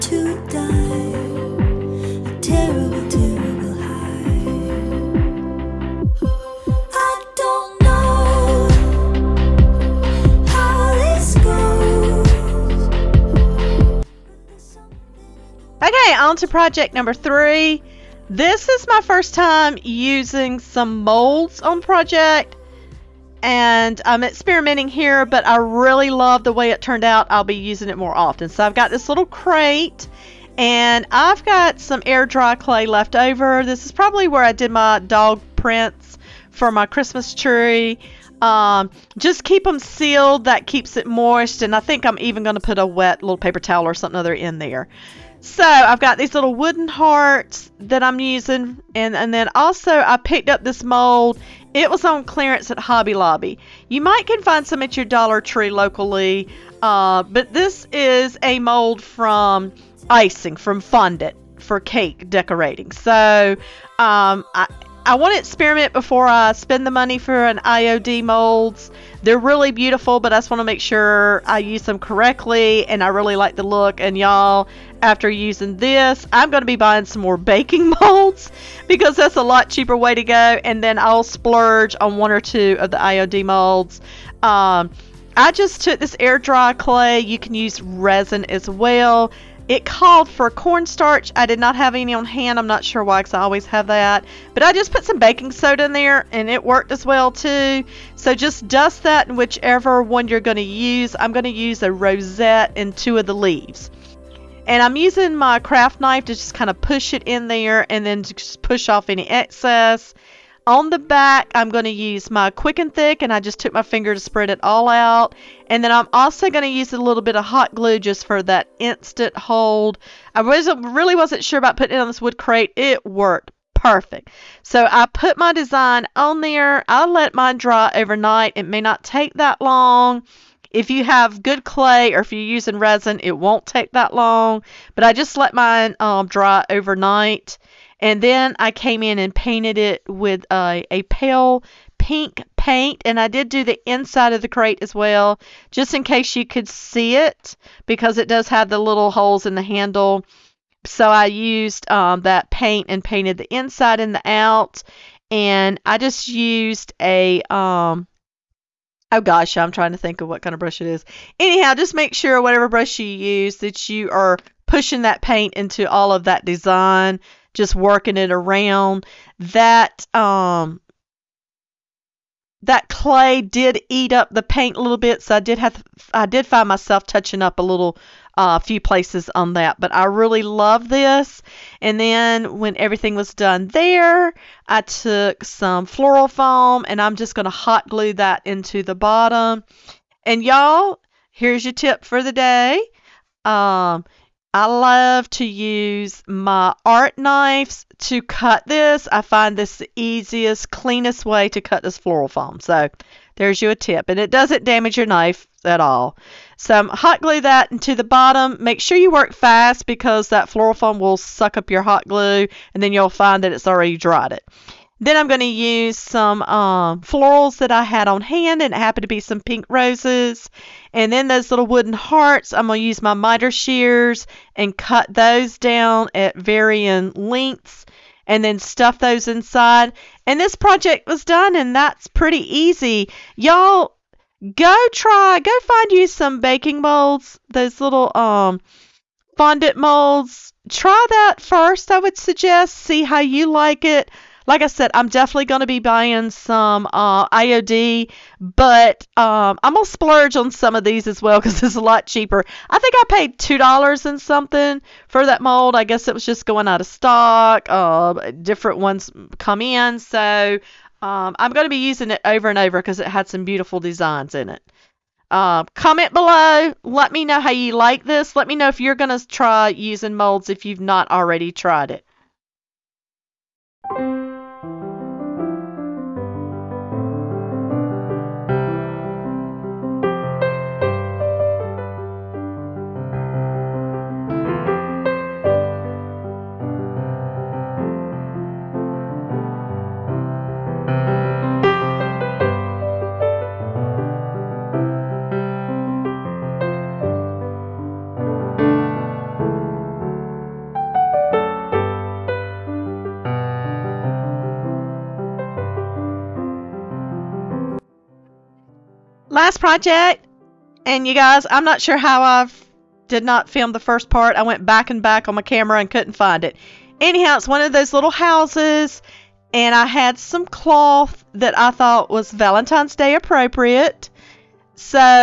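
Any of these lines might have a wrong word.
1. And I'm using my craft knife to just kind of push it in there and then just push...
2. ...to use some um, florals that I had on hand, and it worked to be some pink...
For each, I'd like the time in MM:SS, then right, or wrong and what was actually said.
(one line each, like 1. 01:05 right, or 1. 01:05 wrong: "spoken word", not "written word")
1. 01:44 right
2. 03:35 wrong: "happened", not "worked".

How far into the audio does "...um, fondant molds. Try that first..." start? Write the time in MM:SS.
03:58.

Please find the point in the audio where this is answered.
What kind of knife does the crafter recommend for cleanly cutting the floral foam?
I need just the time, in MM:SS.
03:16.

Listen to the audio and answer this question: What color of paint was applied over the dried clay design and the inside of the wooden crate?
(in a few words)
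pale pink.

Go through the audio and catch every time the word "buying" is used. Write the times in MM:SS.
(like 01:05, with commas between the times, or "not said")
01:16, 04:05.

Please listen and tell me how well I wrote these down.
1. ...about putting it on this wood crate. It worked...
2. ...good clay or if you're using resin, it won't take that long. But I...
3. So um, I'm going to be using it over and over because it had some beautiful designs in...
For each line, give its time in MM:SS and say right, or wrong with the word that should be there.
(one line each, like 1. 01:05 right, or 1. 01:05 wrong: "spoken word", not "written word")
1. 02:01 right
2. 02:11 right
3. 04:19 right.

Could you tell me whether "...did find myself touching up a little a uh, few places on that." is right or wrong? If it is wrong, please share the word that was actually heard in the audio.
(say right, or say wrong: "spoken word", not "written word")
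right.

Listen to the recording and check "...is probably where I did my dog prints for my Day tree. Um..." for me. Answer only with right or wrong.
wrong.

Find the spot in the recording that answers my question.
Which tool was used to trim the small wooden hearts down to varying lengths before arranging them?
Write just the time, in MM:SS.
03:43.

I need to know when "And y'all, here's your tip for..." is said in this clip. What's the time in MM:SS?
03:10.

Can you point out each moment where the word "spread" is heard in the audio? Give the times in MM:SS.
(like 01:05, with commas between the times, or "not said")
01:54.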